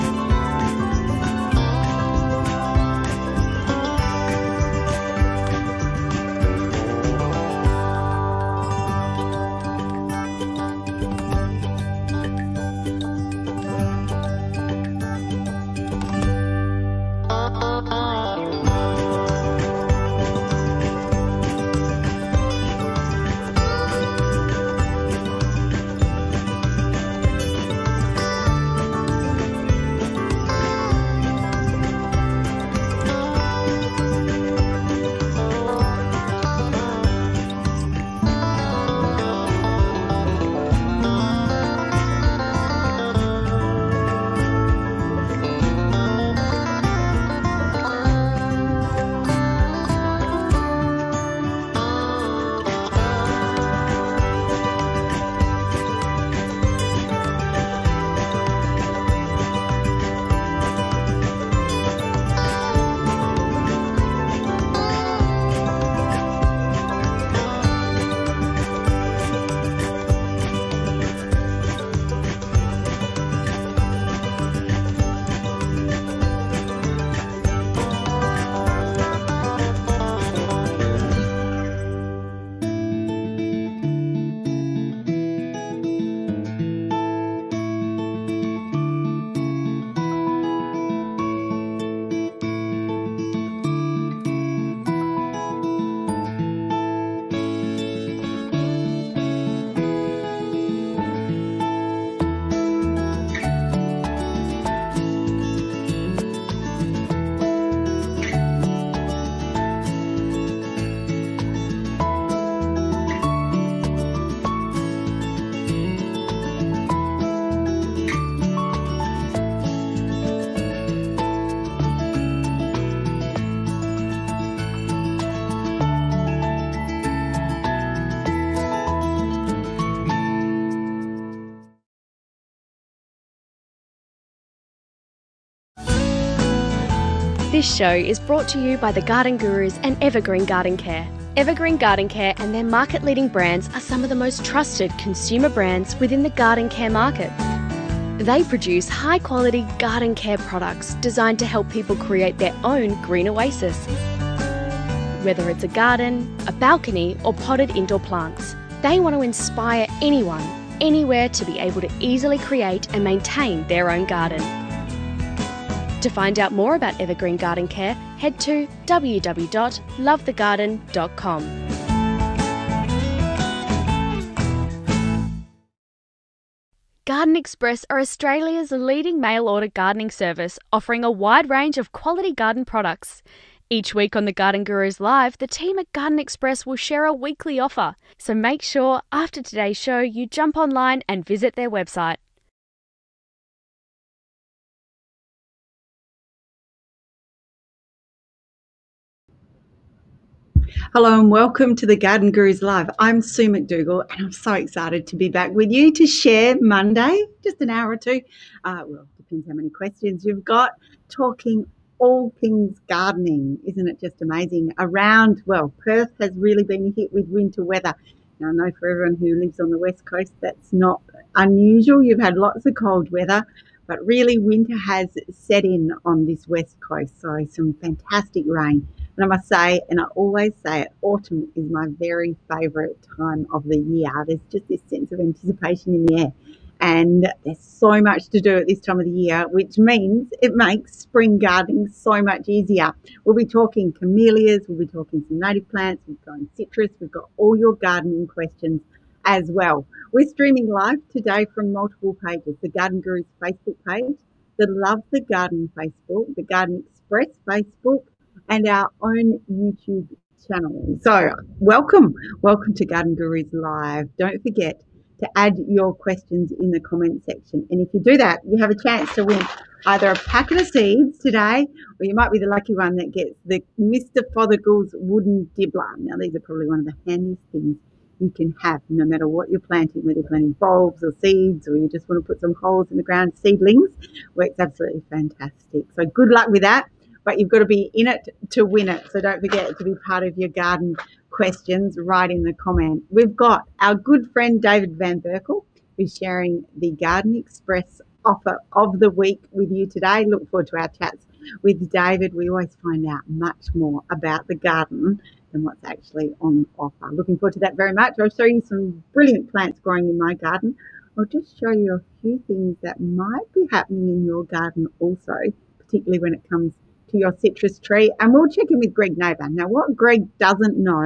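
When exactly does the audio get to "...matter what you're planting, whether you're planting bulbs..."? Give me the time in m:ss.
4:39.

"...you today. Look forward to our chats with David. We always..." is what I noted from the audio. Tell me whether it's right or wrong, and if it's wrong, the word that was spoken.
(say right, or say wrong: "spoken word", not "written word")
right.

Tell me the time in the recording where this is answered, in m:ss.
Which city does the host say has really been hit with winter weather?
3:35.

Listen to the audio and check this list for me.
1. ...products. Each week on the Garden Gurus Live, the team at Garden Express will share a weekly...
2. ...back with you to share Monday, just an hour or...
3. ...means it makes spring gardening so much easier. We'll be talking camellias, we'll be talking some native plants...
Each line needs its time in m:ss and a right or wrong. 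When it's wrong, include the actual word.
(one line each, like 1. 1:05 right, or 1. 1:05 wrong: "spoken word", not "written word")
1. 3:02 right
2. 3:25 right
3. 3:59 right.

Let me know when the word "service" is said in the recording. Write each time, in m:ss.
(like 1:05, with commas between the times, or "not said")
3:00.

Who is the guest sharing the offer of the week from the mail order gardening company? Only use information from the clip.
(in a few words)
David Van Berkel.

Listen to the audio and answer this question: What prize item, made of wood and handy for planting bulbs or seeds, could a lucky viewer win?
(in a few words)
Wooden dibbler.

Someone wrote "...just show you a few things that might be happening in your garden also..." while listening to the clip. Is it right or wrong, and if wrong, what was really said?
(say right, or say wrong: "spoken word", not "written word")
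right.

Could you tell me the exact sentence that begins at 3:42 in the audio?
You've had lots of cold weather, but really winter has set in on this West Coast.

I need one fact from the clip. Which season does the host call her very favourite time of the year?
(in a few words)
Autumn.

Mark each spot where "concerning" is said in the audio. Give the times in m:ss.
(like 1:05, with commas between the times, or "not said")
not said.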